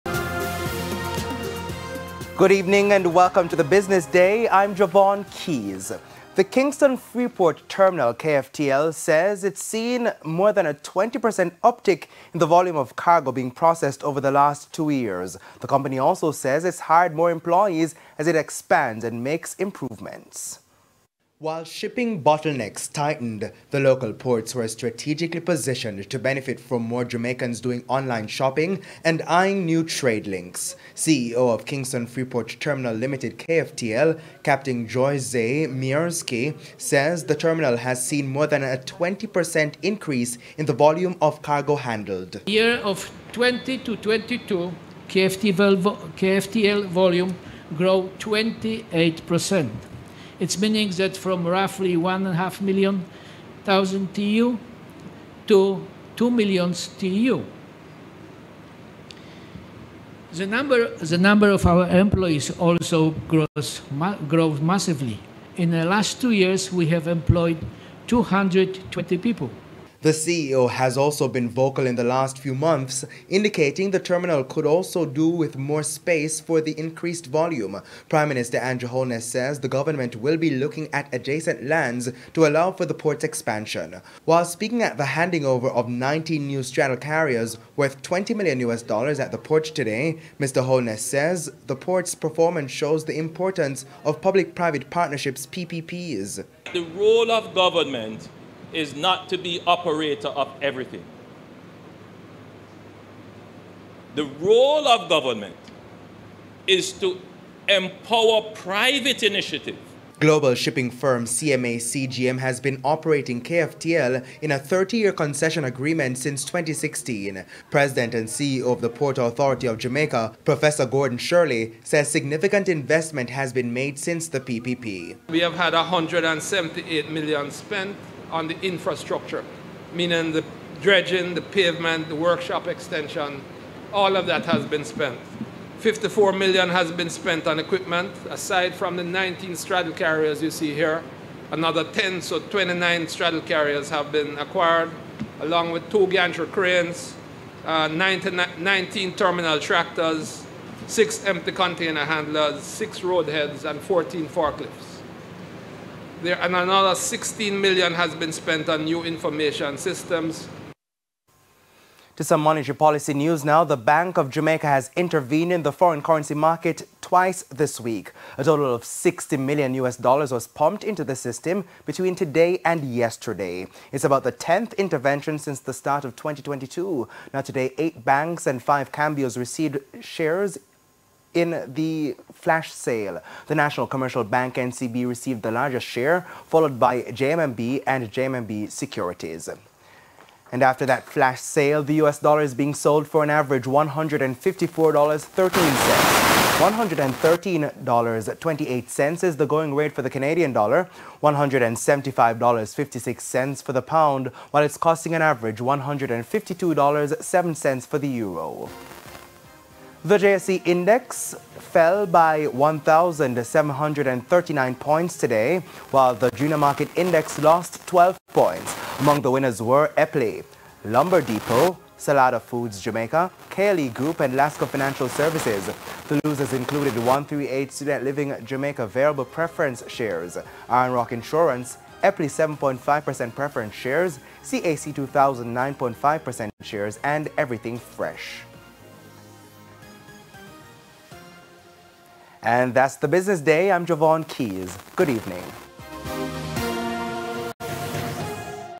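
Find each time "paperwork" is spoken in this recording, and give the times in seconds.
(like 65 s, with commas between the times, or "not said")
not said.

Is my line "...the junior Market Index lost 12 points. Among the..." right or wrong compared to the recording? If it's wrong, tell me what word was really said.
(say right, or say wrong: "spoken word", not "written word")
right.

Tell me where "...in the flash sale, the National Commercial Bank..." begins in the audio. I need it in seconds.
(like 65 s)
181 s.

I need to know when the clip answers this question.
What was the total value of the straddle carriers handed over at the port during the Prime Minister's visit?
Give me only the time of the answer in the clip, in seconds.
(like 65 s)
88 s.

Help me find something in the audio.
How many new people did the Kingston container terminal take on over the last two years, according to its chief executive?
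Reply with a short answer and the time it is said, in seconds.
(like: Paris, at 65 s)
220, at 68 s.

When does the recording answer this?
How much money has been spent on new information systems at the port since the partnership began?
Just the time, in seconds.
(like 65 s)
156 s.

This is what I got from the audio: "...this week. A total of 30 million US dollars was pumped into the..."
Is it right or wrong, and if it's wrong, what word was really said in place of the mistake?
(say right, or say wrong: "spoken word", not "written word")
wrong: "60", not "30".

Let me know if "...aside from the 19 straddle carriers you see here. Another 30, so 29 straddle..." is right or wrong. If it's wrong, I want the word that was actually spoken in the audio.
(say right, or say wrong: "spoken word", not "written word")
wrong: "10", not "30".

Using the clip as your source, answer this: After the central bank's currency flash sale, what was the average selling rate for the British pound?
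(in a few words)
$175.56.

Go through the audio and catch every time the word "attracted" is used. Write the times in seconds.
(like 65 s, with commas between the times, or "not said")
not said.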